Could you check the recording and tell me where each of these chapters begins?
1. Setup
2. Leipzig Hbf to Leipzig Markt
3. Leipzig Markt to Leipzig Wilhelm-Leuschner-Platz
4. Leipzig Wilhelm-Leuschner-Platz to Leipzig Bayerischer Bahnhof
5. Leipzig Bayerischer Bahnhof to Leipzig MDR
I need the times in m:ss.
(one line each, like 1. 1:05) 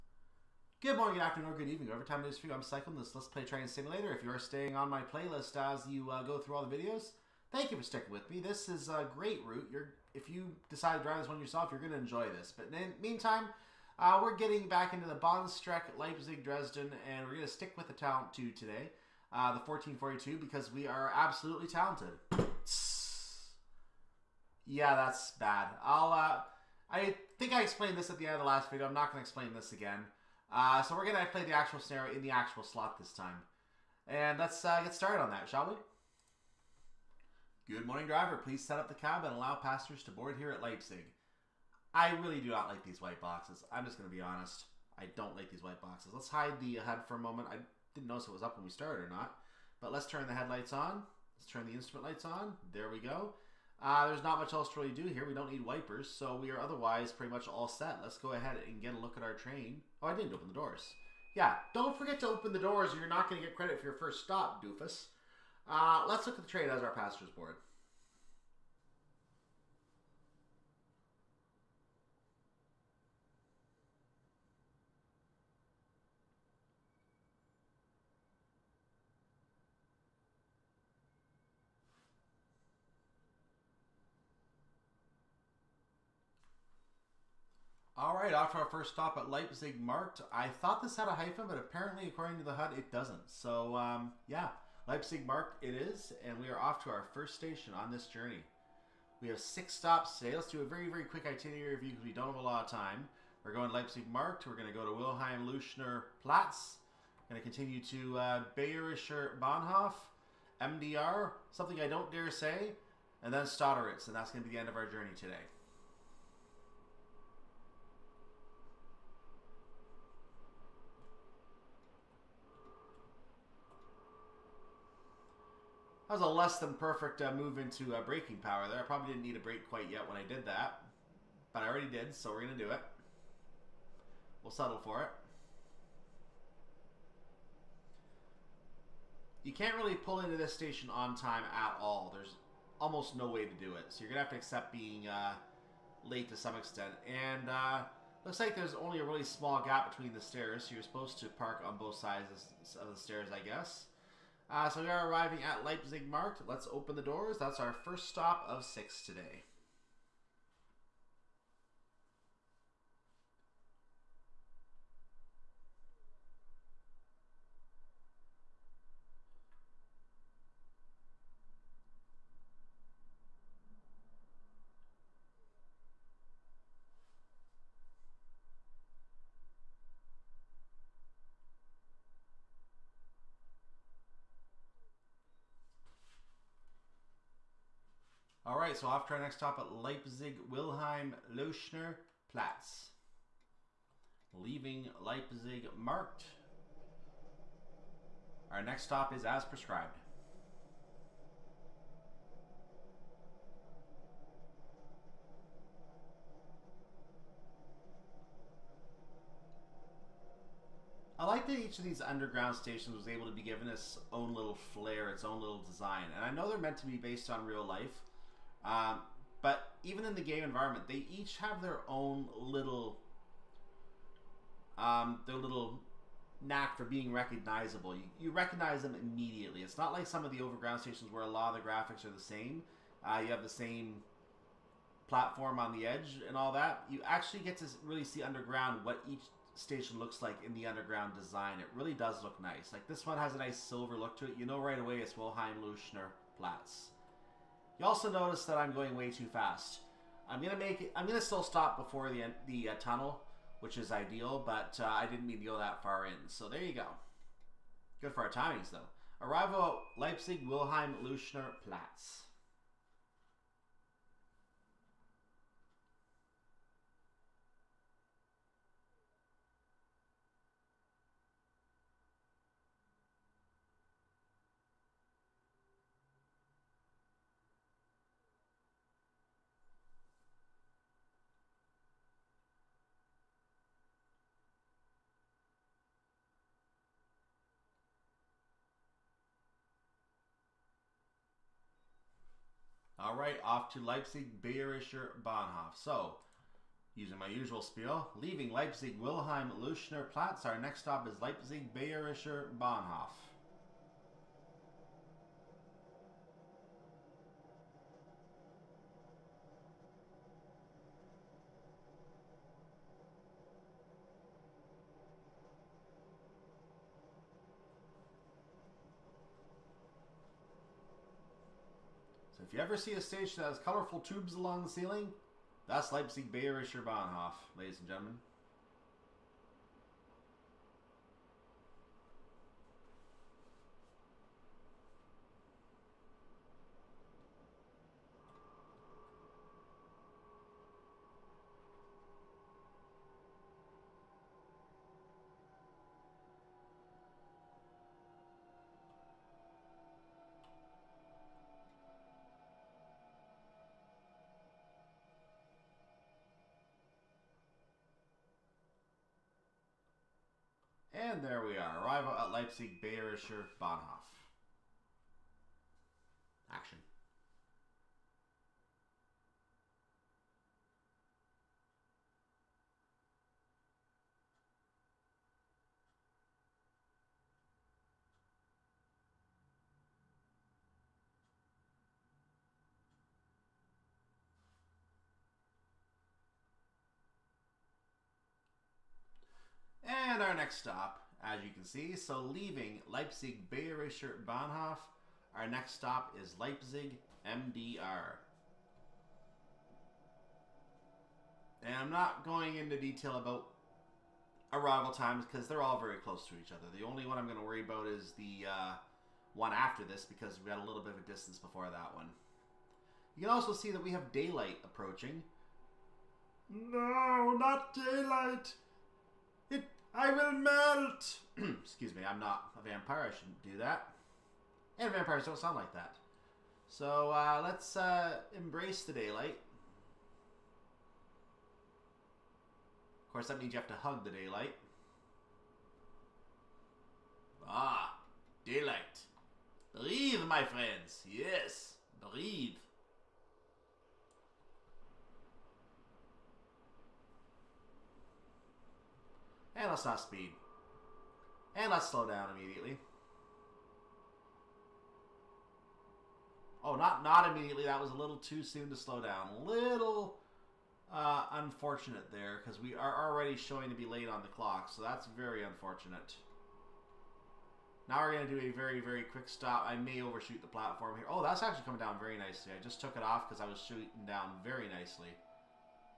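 1. 0:36
2. 1:26
3. 3:04
4. 4:50
5. 6:28.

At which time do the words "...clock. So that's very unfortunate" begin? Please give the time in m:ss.
7:44.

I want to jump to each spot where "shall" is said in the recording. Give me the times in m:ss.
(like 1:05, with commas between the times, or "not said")
0:35.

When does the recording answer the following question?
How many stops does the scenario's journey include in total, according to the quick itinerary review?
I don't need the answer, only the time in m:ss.
1:39.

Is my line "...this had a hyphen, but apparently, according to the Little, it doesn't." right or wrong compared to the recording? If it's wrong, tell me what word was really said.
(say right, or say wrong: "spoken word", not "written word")
wrong: "HUD", not "Little".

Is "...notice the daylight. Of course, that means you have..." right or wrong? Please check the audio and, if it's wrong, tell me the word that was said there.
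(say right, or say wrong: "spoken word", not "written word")
wrong: "embrace", not "notice".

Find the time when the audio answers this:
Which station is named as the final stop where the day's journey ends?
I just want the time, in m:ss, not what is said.
1:53.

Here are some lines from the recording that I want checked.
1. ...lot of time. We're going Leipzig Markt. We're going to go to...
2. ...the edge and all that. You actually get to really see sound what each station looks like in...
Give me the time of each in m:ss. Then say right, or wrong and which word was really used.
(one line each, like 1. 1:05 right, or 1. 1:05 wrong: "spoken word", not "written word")
1. 1:42 right
2. 3:55 wrong: "underground", not "sound".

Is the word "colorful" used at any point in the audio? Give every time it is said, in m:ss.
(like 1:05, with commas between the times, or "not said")
5:23.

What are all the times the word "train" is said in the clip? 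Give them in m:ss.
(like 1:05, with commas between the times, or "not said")
0:03, 0:59, 1:06.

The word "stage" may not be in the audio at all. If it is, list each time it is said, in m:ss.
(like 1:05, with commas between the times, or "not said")
5:23.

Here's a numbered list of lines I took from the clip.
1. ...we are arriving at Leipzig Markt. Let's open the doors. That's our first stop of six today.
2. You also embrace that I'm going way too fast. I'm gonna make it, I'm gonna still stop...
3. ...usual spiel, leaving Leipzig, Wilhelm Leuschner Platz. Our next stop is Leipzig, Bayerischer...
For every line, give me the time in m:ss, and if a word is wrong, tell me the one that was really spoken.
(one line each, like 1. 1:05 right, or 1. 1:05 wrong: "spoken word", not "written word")
1. 2:34 right
2. 4:07 wrong: "notice", not "embrace"
3. 4:57 right.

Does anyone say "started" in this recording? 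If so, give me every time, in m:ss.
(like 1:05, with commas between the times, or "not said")
0:34, 0:48.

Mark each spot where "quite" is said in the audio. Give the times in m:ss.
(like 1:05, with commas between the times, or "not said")
2:09.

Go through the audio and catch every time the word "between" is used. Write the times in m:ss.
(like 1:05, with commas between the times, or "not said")
2:29.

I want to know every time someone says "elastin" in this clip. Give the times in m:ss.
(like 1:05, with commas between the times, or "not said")
not said.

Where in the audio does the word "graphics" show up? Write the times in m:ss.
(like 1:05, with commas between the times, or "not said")
3:51.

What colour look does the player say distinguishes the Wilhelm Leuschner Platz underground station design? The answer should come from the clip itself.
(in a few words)
Silver.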